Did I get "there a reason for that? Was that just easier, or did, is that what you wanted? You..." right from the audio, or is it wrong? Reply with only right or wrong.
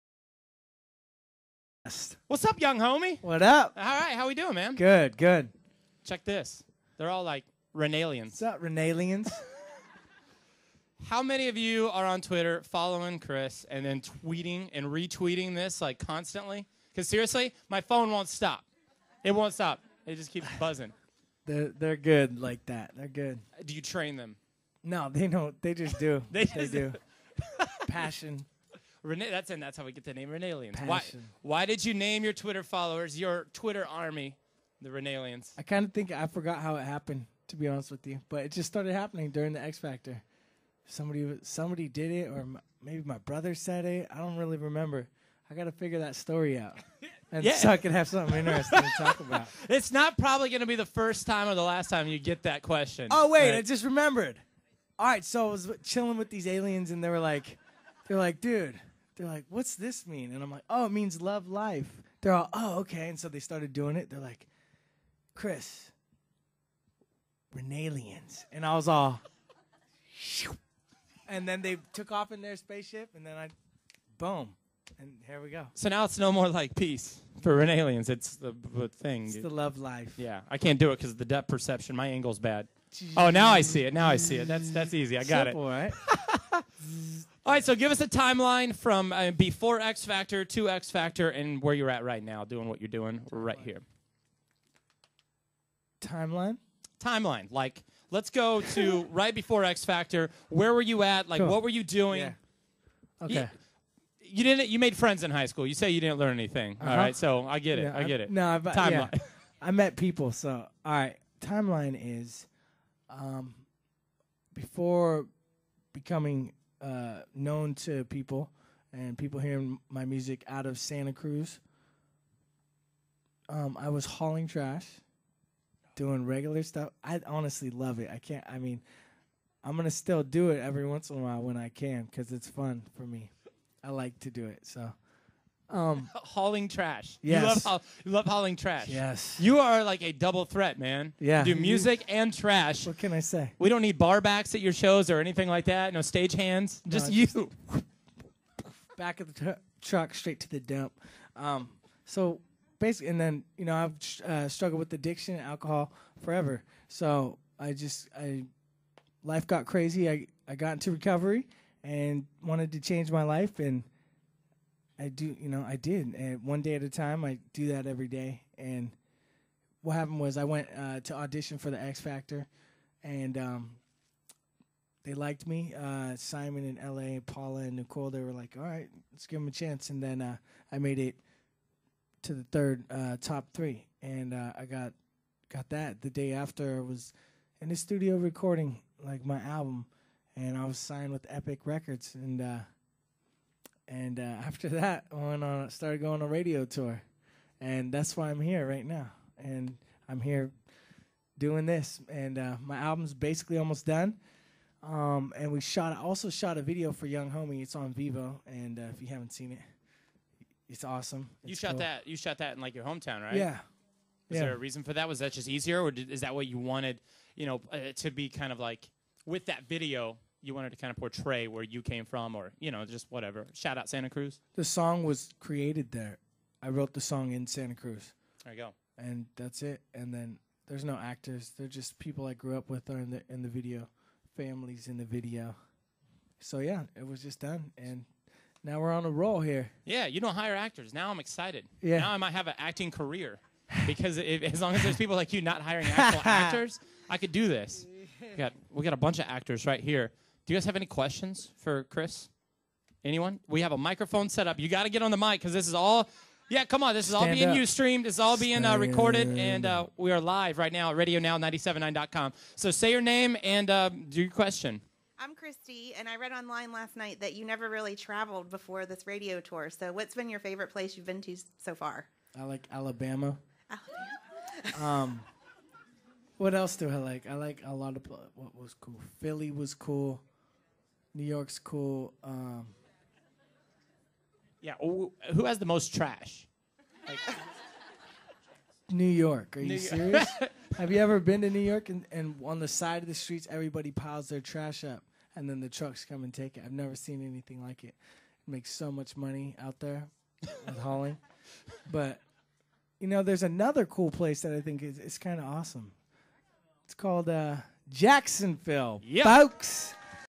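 right.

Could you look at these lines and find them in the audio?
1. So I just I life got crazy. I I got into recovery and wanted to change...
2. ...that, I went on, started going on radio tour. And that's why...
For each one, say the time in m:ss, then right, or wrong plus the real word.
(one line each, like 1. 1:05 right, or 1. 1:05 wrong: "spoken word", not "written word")
1. 2:36 right
2. 3:14 right.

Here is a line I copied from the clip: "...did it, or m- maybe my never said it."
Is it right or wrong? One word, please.
wrong.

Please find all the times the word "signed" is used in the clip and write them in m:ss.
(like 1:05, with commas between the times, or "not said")
3:10.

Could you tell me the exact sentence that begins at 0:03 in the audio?
All right, how we doing, man?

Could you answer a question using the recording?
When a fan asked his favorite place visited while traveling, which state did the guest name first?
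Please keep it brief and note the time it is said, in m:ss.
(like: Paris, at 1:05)
Alabama, at 4:32.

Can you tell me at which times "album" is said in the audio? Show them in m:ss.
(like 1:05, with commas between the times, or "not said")
3:09, 3:22.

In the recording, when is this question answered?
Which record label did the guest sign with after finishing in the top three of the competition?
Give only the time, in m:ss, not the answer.
3:11.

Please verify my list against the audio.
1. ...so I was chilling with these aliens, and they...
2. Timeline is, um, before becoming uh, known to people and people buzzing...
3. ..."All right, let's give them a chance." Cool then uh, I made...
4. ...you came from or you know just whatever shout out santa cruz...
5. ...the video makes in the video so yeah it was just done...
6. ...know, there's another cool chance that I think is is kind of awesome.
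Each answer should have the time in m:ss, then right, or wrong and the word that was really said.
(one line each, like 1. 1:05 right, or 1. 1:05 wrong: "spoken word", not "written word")
1. 0:55 right
2. 1:51 wrong: "hearing", not "buzzing"
3. 2:58 wrong: "And", not "Cool"
4. 3:41 right
5. 3:53 wrong: "families", not "makes"
6. 5:03 wrong: "place", not "chance".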